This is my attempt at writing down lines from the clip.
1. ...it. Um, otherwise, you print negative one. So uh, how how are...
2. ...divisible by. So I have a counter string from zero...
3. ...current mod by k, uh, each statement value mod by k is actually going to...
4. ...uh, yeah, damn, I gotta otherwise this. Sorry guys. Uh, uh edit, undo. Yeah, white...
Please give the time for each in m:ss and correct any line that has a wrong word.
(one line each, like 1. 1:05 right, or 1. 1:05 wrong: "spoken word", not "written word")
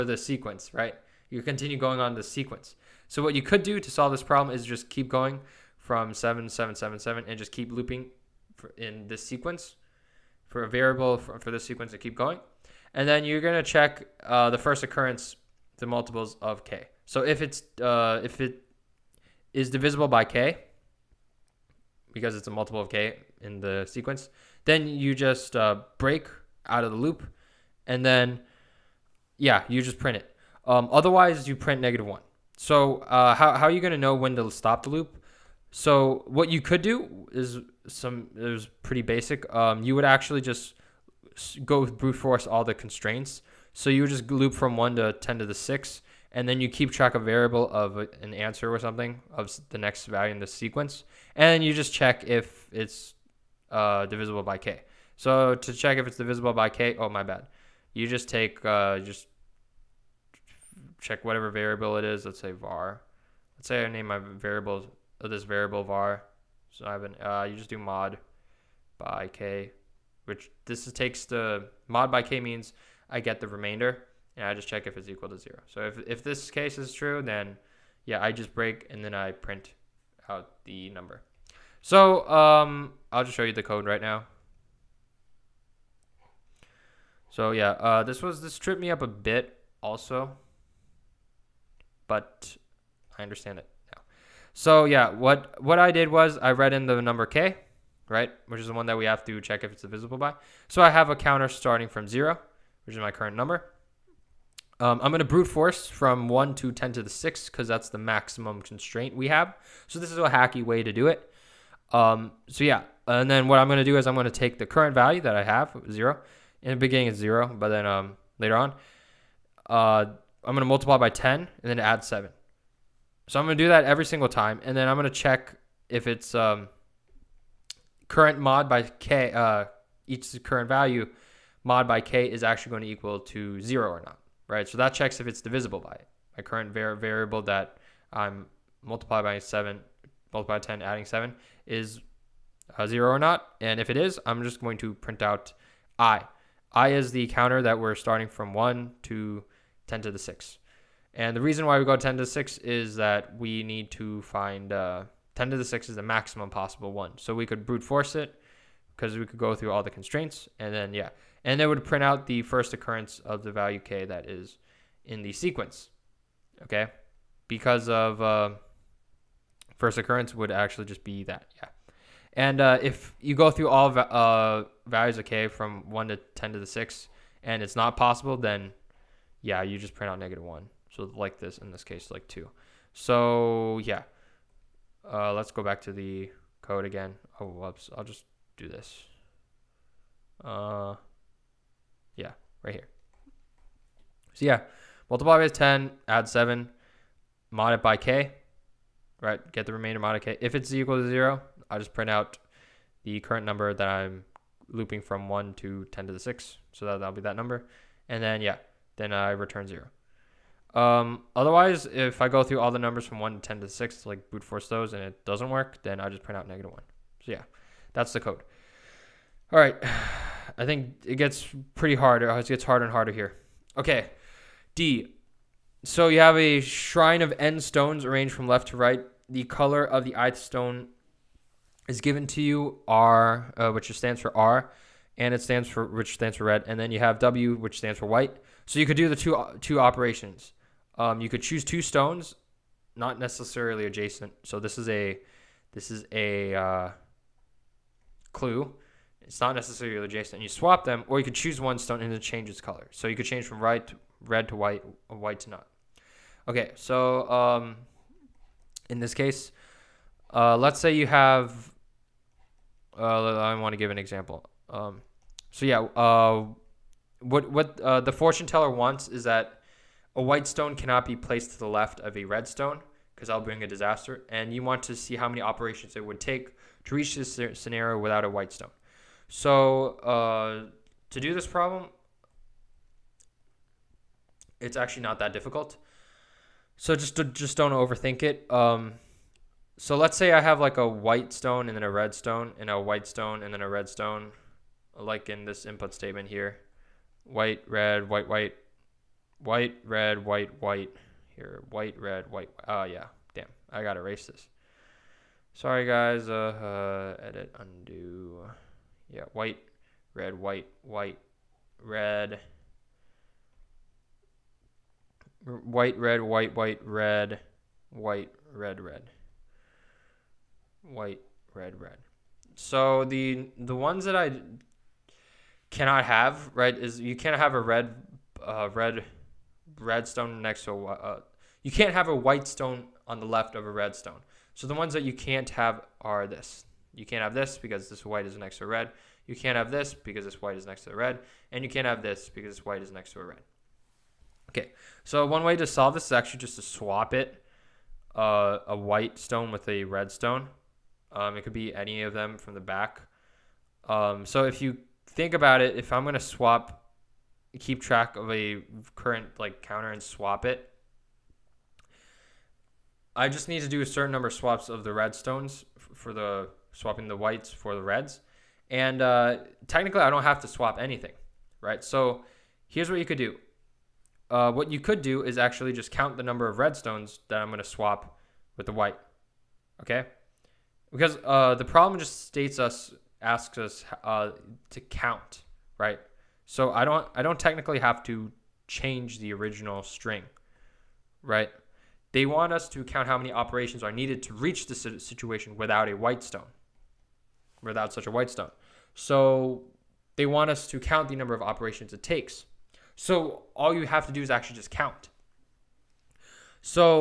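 1. 0:30 right
2. 1:39 wrong: "starting", not "string"
3. 2:08 wrong: "current", not "statement"
4. 5:02 wrong: "erase", not "otherwise".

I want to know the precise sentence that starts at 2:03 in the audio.
So I'm going to do that every single time.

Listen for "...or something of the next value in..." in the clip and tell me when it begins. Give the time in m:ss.
0:48.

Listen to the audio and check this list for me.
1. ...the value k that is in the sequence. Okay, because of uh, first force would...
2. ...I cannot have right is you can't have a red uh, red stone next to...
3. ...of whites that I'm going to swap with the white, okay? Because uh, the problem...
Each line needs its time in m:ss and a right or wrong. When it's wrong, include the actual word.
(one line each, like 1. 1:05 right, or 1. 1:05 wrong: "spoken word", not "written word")
1. 2:43 wrong: "occurrence", not "force"
2. 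5:24 wrong: "redstone", not "stone"
3. 6:16 wrong: "redstones", not "whites".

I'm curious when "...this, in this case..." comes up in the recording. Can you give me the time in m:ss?
3:01.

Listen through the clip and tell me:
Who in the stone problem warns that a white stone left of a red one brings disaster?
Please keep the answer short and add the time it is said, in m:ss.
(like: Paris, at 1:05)
The fortune teller, at 4:28.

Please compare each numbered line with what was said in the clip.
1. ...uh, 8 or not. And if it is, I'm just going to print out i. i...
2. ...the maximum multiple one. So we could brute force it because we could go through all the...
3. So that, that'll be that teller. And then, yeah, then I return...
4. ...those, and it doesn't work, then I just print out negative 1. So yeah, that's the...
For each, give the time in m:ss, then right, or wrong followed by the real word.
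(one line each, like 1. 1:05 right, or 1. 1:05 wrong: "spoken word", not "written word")
1. 2:22 wrong: "0", not "8"
2. 2:35 wrong: "possible", not "multiple"
3. 3:26 wrong: "number", not "teller"
4. 3:34 right.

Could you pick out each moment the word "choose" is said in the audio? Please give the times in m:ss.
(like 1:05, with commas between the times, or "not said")
4:01, 4:11.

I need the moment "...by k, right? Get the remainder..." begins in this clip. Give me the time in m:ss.
3:17.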